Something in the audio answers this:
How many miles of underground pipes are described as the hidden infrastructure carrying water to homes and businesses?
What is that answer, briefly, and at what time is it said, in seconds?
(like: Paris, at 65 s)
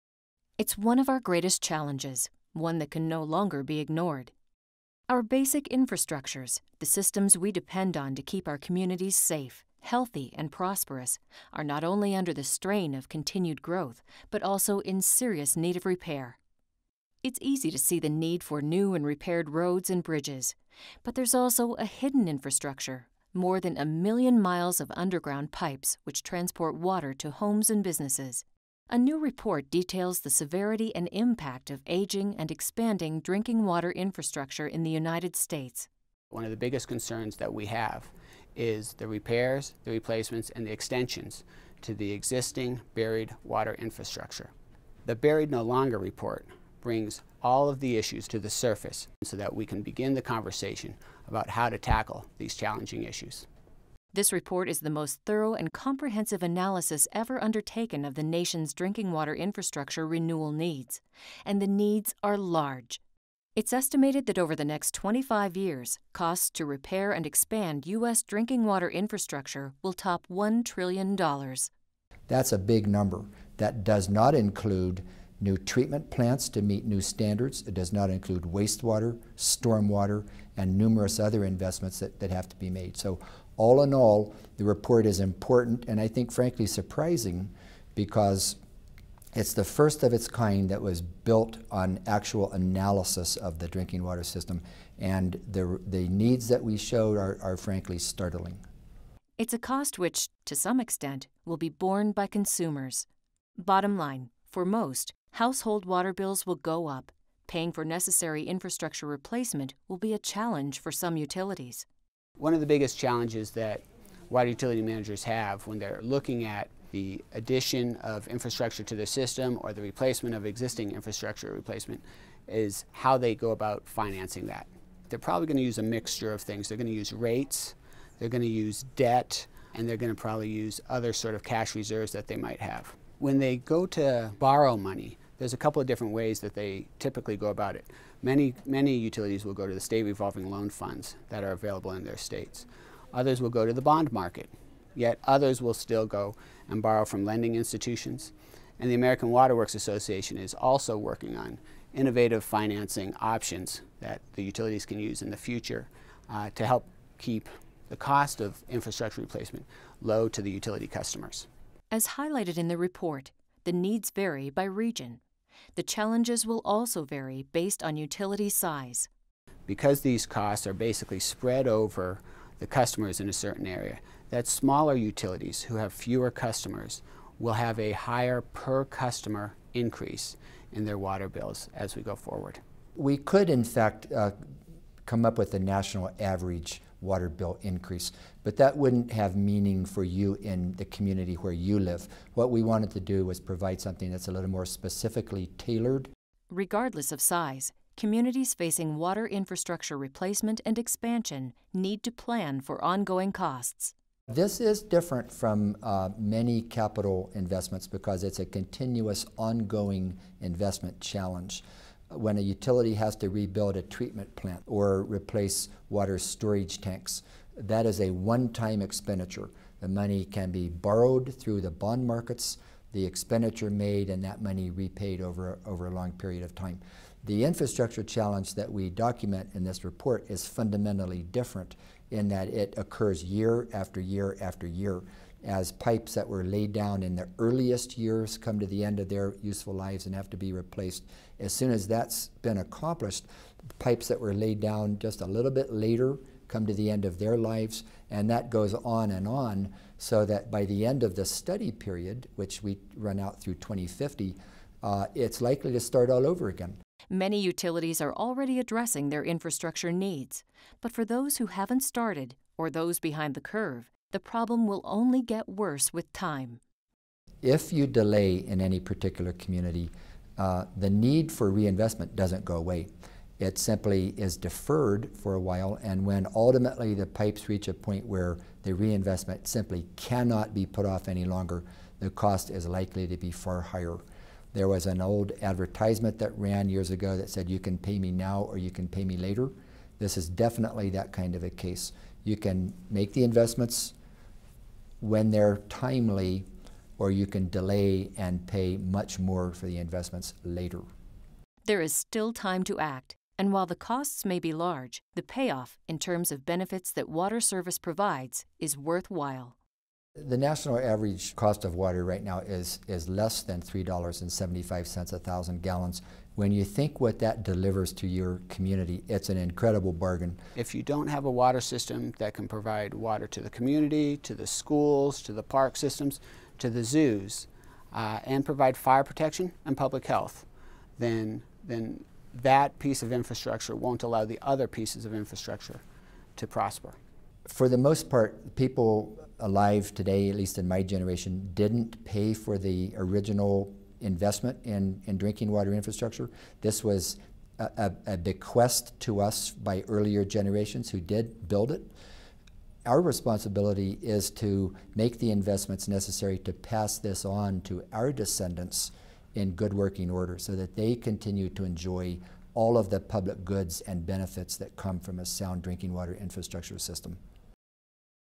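more than a million miles, at 23 s.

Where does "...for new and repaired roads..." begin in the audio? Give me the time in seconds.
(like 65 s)
18 s.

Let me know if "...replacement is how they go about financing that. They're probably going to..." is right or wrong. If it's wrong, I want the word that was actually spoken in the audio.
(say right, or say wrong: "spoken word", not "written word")
right.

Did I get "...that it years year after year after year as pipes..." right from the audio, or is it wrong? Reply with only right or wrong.
wrong.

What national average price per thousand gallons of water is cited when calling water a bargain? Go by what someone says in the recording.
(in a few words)
less than $3.75.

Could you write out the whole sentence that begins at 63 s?
It's estimated that over the next 25 years, costs to repair and expand U.S.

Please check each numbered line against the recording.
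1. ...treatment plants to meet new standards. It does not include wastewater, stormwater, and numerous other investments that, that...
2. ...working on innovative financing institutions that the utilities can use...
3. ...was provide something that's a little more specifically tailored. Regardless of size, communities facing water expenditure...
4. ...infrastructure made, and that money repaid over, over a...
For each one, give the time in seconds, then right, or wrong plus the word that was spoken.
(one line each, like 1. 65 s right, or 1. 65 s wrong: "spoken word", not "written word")
1. 75 s right
2. 150 s wrong: "options", not "institutions"
3. 193 s wrong: "infrastructure", not "expenditure"
4. 223 s wrong: "expenditure", not "infrastructure".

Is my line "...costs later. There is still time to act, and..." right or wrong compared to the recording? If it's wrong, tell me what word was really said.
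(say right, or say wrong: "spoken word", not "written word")
wrong: "investments", not "costs".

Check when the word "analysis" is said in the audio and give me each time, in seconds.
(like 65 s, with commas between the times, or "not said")
56 s, 92 s.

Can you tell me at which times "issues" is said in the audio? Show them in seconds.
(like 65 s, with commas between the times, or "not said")
47 s, 53 s.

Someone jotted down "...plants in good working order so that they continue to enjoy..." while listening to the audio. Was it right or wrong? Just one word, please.
wrong.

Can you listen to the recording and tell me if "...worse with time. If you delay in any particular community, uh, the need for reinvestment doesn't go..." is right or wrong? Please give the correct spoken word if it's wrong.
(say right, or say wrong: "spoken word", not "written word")
right.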